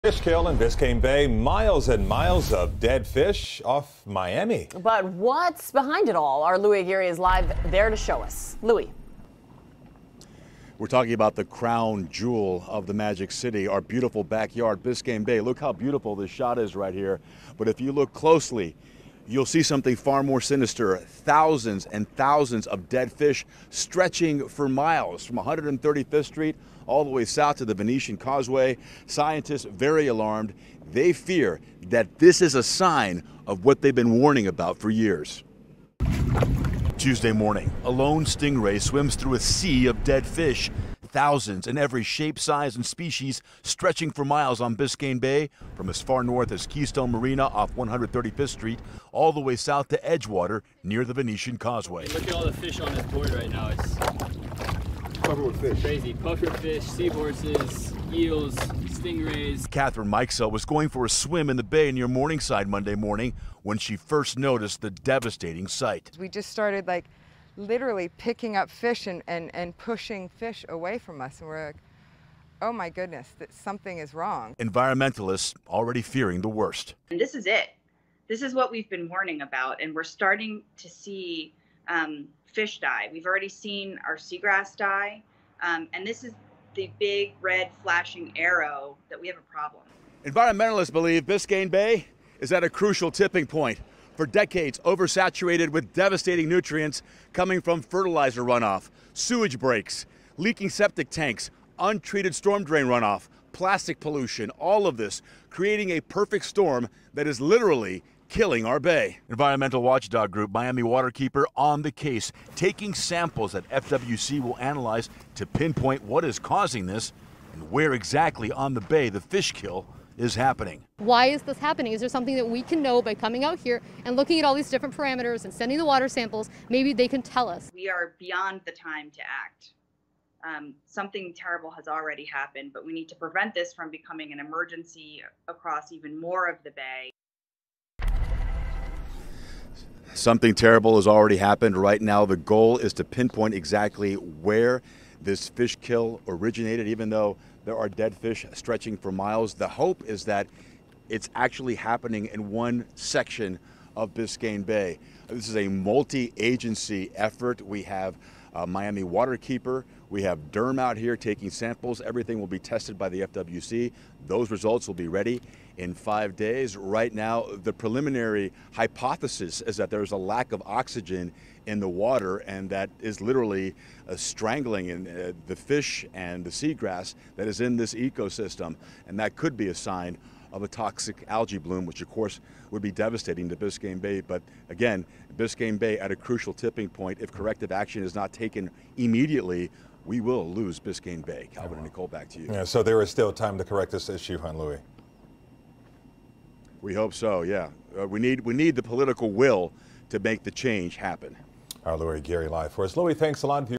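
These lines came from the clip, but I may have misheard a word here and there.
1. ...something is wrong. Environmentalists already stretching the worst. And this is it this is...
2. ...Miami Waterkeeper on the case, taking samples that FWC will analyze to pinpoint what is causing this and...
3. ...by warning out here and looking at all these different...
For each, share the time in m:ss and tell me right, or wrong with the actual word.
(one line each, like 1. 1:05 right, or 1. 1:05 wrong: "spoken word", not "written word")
1. 1:13 wrong: "fearing", not "stretching"
2. 1:50 right
3. 2:03 wrong: "coming", not "warning".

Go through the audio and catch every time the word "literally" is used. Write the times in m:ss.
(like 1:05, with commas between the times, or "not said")
1:07, 1:47, 2:53.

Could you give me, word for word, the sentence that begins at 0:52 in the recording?
look at all the fish on this board right now.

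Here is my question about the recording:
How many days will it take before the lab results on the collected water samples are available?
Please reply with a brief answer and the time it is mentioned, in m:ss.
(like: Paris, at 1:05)
5, at 2:45.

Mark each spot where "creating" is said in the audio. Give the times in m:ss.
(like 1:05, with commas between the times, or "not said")
1:45.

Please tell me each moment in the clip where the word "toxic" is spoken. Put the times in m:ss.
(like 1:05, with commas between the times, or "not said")
3:00.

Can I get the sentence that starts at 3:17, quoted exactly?
Uh, we, need, we need the political will to make the change happen.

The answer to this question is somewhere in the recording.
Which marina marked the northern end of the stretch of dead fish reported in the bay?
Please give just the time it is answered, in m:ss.
0:46.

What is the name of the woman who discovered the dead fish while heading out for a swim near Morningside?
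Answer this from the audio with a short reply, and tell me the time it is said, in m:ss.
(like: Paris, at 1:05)
Catherine Mikesell, at 0:59.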